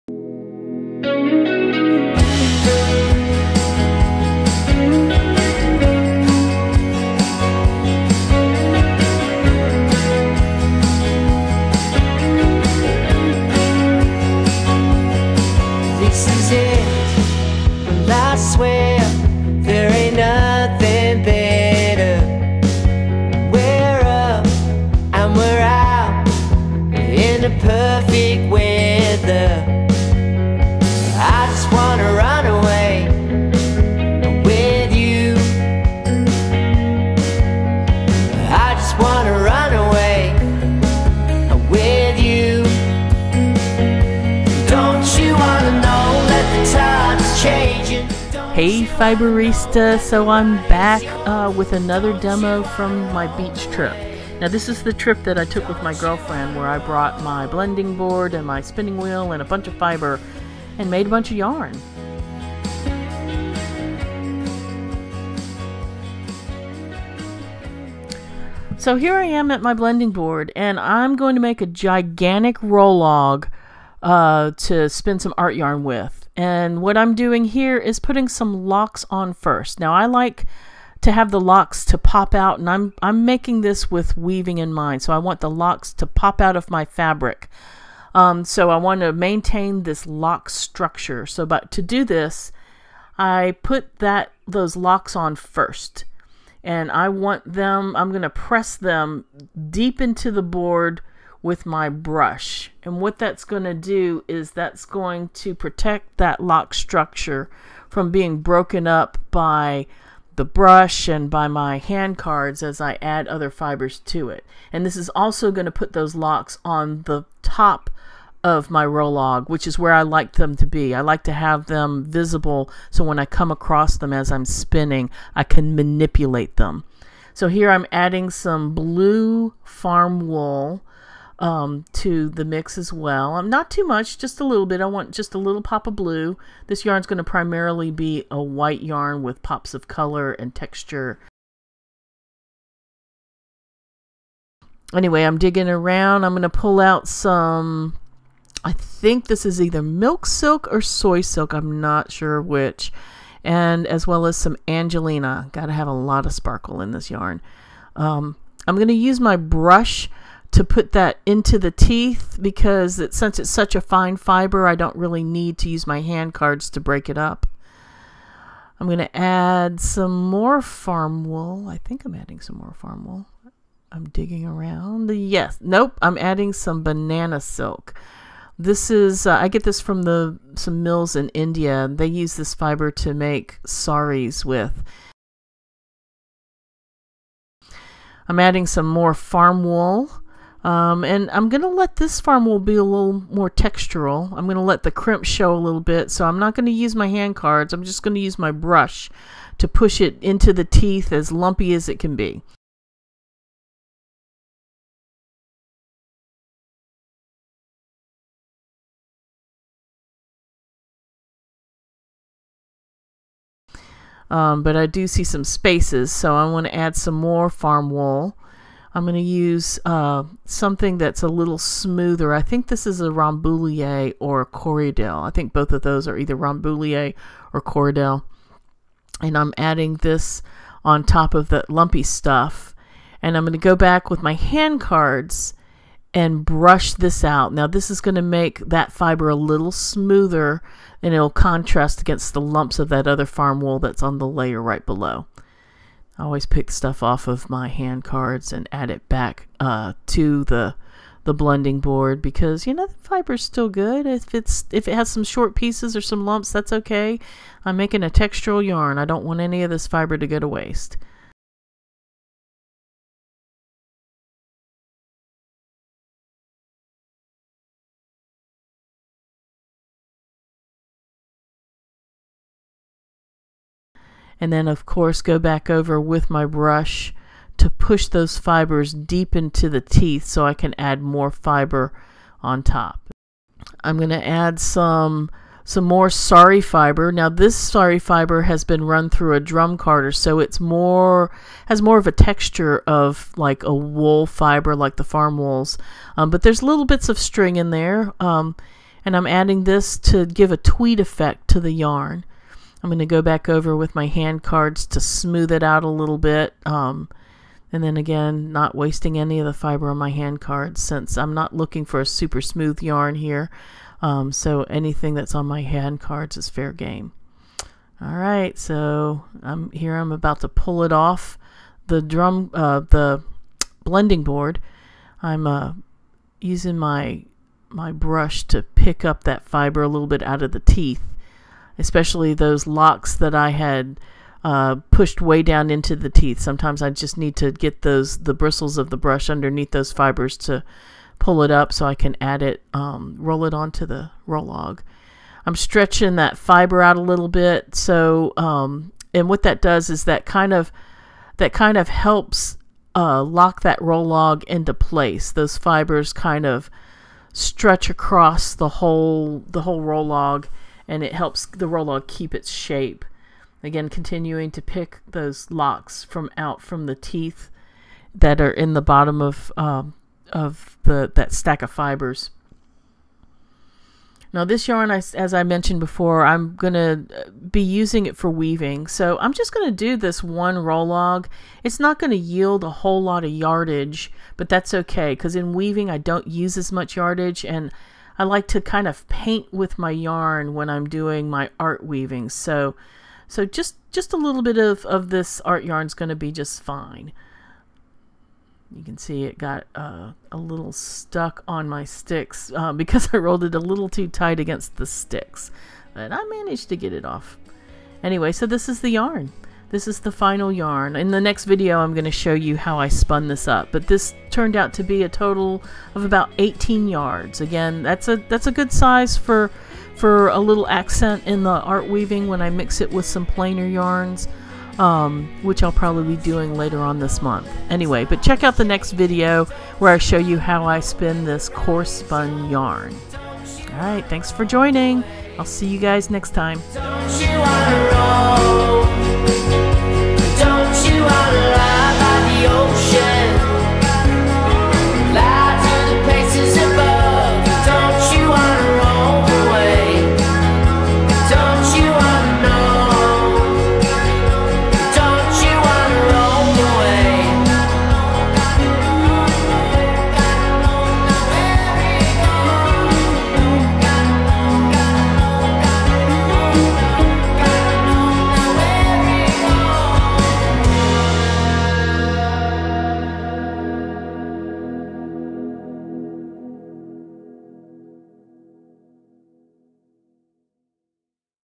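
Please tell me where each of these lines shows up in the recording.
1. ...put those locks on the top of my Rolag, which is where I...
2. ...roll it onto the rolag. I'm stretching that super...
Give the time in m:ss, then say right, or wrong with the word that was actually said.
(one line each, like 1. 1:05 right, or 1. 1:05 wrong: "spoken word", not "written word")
1. 1:55 right
2. 5:43 wrong: "fiber", not "super".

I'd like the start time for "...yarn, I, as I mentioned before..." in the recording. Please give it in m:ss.
6:14.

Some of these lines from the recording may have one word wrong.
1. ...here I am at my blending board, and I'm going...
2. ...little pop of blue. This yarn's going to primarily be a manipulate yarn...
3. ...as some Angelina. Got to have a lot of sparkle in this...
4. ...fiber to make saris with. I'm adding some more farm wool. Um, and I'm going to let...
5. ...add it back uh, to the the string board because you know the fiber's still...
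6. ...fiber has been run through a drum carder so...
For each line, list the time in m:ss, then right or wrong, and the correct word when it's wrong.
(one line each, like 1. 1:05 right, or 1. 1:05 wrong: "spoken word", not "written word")
1. 1:08 right
2. 2:15 wrong: "white", not "manipulate"
3. 2:34 right
4. 3:02 right
5. 4:08 wrong: "blending", not "string"
6. 4:47 right.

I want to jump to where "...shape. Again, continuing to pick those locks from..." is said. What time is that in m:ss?
6:02.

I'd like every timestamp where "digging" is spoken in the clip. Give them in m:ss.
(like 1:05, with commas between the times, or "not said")
2:25, 2:54.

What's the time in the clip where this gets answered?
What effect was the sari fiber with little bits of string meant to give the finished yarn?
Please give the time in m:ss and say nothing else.
5:00.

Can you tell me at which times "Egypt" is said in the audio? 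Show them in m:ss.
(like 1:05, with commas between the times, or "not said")
not said.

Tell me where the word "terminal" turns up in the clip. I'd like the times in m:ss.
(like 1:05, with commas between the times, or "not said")
not said.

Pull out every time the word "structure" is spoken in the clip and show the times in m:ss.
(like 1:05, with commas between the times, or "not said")
1:30, 1:46.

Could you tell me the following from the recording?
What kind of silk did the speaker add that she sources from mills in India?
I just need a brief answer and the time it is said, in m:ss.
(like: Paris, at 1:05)
Banana silk, at 2:56.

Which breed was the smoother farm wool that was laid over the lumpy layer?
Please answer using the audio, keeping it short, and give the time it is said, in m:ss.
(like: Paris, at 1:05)
Rambouillet or Corriedale, at 3:43.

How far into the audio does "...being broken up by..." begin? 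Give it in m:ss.
1:48.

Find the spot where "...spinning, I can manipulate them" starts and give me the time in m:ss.
2:04.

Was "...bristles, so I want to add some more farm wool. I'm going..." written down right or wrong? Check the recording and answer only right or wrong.
wrong.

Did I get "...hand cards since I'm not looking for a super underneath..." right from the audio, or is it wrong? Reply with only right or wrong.
wrong.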